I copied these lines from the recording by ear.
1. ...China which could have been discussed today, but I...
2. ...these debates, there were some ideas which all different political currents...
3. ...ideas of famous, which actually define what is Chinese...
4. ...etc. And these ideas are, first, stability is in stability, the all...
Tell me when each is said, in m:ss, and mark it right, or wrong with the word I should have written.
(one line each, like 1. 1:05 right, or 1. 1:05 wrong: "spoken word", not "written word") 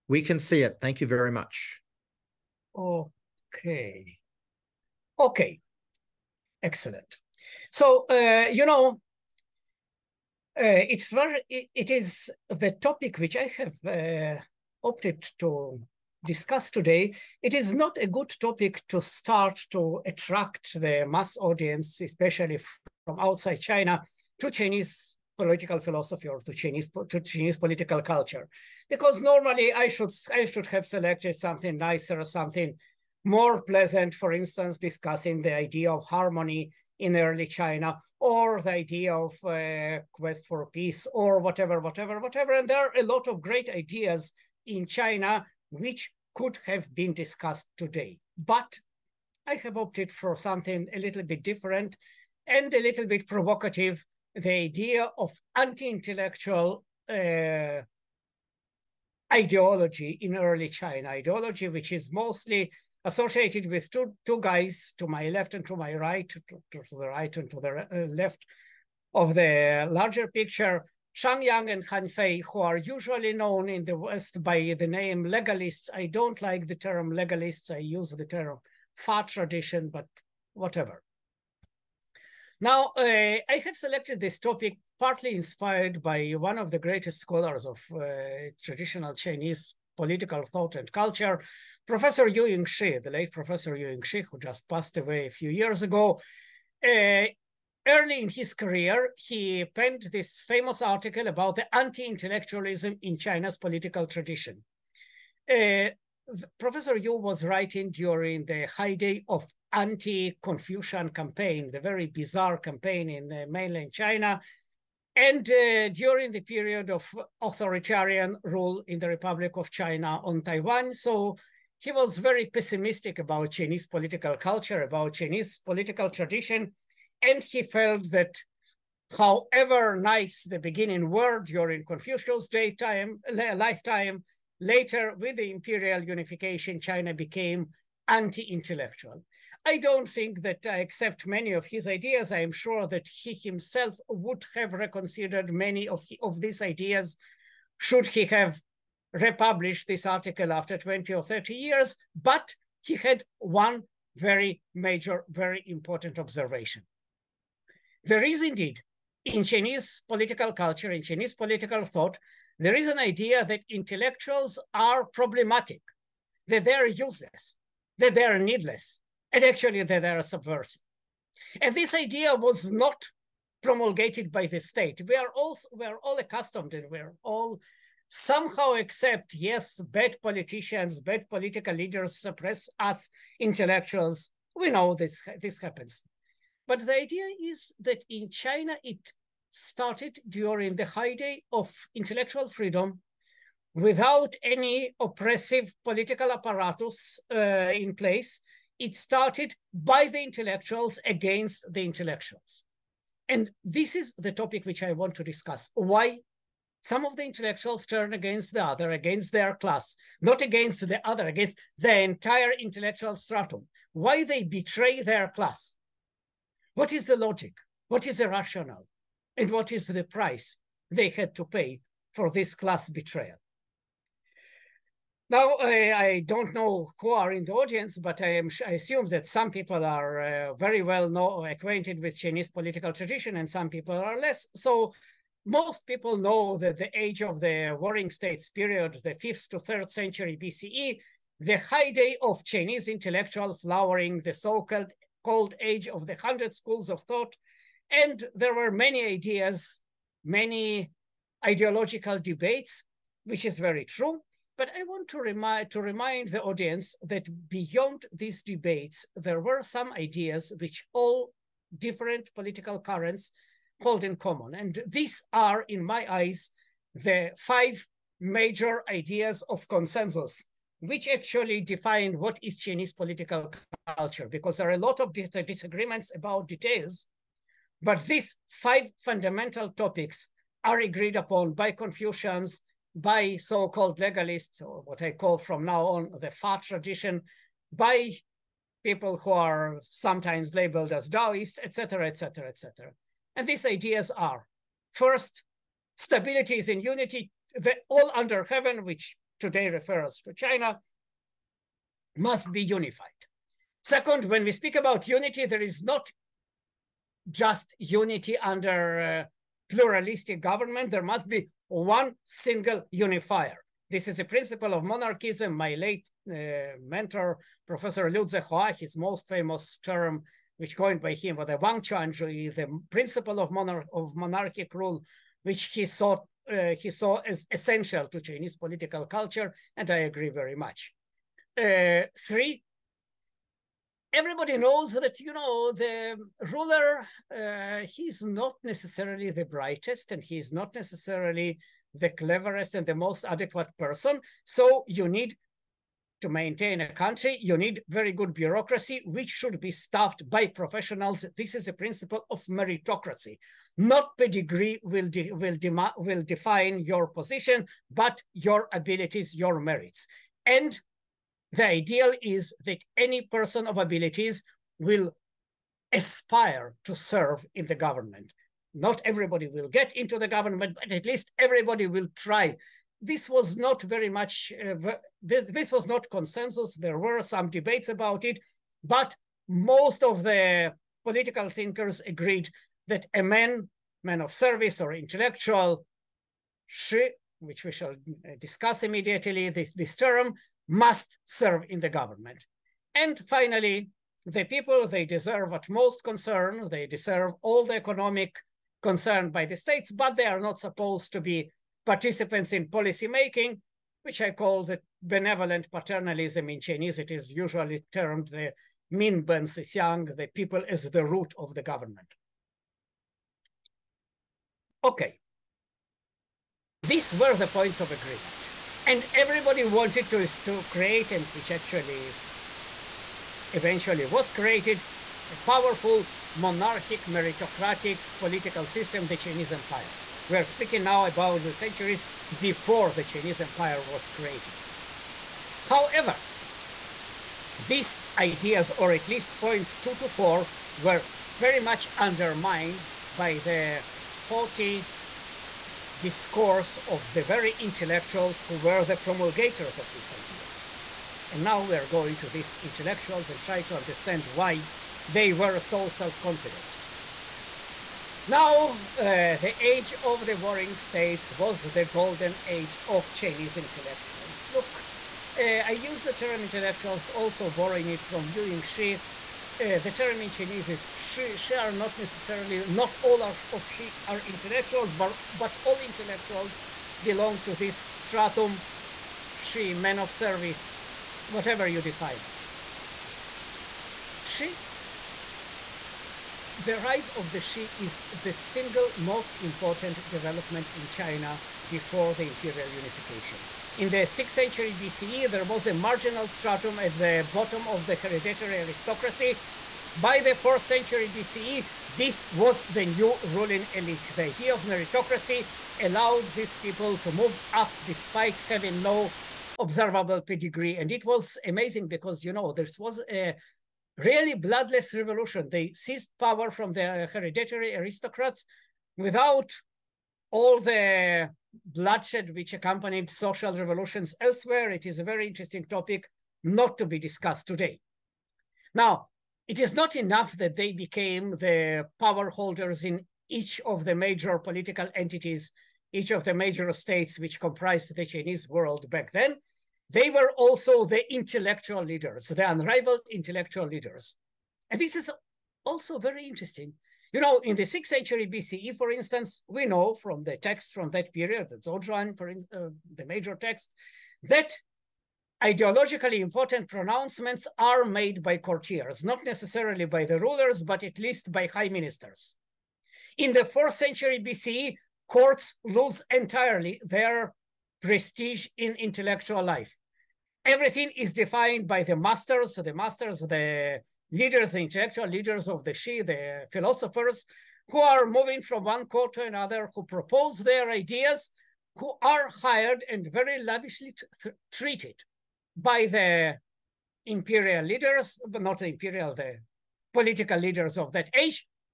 1. 0:44 right
2. 4:18 right
3. 4:28 wrong: "consensus", not "famous"
4. 4:52 wrong: "unity", not "stability".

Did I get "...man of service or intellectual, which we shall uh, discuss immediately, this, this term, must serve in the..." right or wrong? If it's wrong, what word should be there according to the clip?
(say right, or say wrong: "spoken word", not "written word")
right.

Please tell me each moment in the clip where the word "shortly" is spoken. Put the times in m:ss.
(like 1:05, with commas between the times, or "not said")
not said.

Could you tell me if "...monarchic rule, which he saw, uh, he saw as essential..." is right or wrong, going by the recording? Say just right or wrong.
right.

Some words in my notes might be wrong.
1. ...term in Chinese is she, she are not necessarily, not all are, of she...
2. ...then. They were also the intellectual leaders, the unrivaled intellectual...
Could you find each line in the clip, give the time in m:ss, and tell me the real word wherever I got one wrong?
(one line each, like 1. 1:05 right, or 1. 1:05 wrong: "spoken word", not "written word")
1. 7:49 right
2. 8:59 right.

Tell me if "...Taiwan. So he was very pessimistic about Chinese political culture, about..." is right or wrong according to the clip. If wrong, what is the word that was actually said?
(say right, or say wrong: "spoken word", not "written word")
right.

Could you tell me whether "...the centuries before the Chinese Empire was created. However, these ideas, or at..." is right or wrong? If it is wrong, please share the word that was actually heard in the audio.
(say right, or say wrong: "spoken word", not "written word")
right.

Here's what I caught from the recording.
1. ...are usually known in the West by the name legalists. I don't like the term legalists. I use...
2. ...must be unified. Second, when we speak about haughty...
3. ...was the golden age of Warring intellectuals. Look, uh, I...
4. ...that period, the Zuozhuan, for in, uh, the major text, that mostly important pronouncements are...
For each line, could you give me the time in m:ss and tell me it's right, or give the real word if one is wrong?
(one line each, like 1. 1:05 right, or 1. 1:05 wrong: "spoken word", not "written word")
1. 1:12 right
2. 5:02 wrong: "unity", not "haughty"
3. 7:41 wrong: "Chinese", not "Warring"
4. 9:10 wrong: "ideologically", not "mostly".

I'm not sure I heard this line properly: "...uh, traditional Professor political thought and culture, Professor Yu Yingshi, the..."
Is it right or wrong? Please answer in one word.
wrong.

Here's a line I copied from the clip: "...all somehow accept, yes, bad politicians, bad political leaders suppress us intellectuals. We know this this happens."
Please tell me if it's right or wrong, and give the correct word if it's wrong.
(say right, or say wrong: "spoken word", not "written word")
right.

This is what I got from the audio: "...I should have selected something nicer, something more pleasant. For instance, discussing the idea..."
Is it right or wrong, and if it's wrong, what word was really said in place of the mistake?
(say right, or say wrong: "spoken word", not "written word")
right.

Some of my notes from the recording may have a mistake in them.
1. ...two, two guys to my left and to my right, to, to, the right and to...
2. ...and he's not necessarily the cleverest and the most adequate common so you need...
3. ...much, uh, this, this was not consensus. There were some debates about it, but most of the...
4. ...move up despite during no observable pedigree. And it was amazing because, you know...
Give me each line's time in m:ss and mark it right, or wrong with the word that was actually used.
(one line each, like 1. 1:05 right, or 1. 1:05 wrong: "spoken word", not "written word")
1. 1:03 right
2. 5:40 wrong: "person", not "common"
3. 6:14 right
4. 8:27 wrong: "having", not "during".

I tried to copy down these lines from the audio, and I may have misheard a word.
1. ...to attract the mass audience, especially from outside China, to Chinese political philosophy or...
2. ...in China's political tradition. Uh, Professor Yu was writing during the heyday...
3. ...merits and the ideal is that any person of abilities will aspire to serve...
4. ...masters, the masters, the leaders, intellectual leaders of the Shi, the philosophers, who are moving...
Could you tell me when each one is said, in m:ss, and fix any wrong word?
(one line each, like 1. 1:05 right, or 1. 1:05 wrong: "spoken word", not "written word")
1. 0:19 right
2. 1:43 right
3. 5:59 right
4. 9:31 right.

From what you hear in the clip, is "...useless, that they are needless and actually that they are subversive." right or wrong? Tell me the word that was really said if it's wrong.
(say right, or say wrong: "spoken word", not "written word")
right.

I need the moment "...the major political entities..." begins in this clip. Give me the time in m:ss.
8:53.